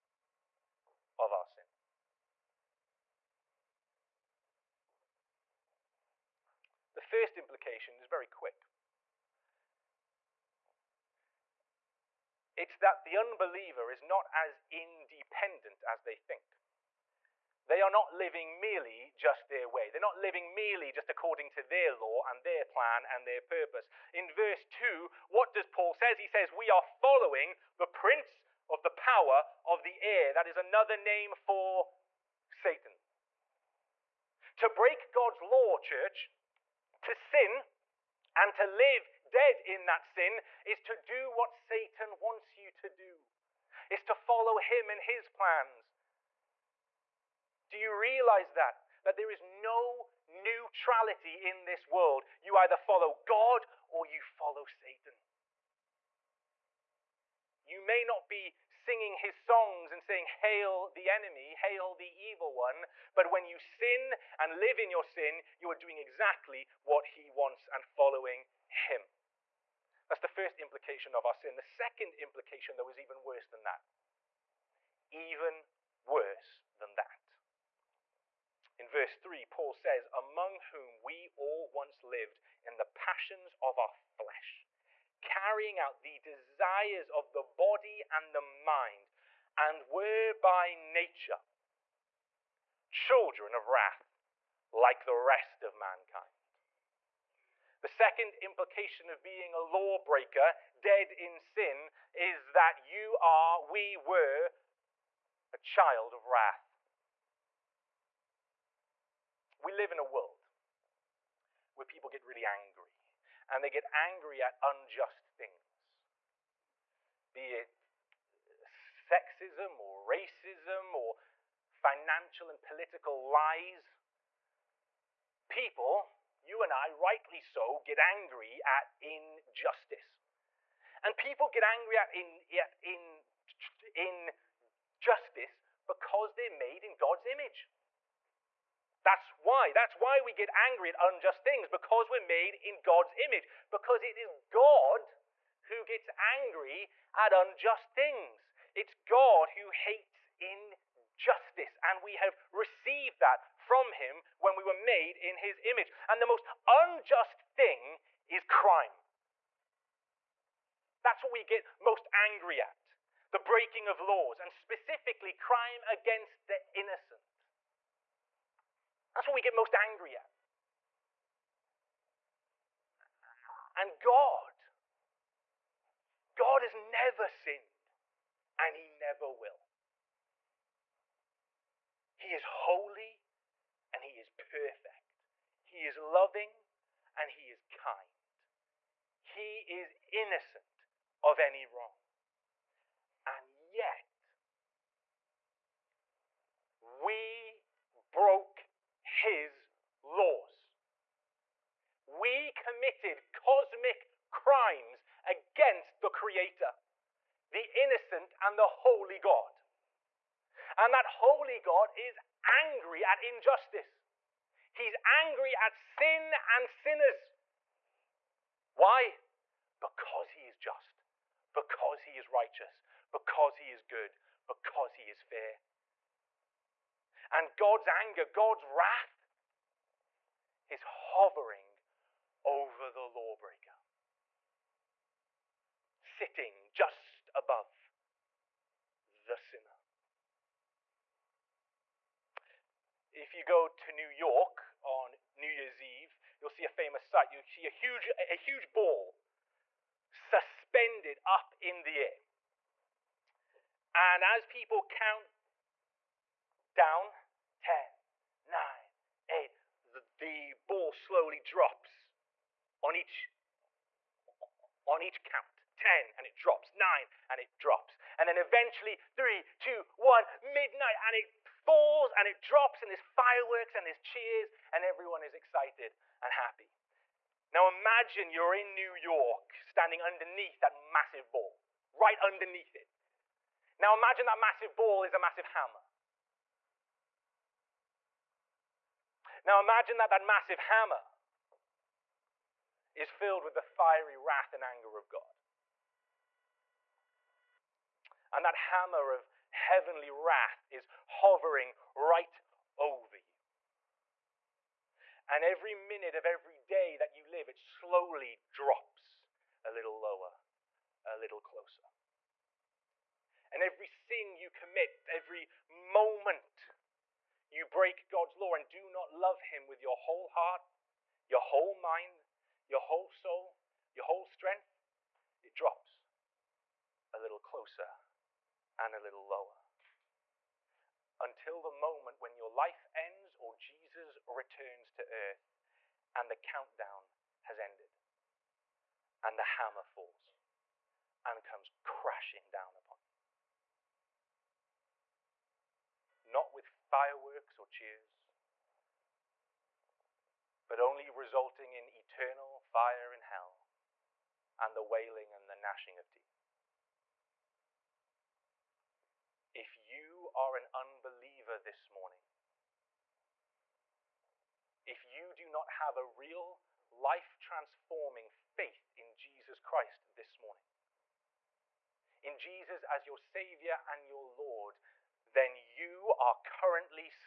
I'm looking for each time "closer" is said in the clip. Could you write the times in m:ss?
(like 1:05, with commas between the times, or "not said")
5:11, 5:27.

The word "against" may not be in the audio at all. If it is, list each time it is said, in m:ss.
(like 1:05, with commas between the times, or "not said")
2:45, 3:25.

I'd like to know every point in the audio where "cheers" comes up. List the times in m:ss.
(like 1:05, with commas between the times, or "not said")
4:33, 5:47.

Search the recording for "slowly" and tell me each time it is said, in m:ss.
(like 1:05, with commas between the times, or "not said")
4:20, 5:07.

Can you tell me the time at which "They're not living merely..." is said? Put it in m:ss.
0:19.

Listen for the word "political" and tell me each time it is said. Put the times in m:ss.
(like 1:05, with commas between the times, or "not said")
2:02.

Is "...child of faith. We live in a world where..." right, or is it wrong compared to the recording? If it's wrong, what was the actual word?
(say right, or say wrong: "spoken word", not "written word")
wrong: "wrath", not "faith".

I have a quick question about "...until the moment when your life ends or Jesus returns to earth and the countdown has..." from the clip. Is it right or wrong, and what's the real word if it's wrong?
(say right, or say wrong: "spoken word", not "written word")
right.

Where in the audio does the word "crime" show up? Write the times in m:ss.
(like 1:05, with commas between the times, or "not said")
2:38, 2:45, 3:24.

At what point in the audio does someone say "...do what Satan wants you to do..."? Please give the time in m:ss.
0:40.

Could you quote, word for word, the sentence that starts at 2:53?
And God, God has never sinned and he never will.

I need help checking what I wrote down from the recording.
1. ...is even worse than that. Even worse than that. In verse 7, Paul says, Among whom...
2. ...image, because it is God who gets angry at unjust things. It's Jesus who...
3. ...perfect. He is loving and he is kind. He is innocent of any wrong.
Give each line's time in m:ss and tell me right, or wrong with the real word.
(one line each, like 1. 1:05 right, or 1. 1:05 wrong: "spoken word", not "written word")
1. 1:12 wrong: "3", not "7"
2. 2:23 wrong: "God", not "Jesus"
3. 3:04 right.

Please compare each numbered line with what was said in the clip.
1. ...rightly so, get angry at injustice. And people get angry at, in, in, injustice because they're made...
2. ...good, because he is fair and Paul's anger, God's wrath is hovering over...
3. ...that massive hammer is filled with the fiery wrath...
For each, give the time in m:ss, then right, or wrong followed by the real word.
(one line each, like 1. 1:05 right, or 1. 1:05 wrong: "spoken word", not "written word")
1. 2:06 right
2. 3:43 wrong: "God", not "Paul"
3. 4:50 right.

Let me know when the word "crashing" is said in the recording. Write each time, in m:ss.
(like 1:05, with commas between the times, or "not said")
5:41.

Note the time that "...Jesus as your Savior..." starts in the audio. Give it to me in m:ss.
6:12.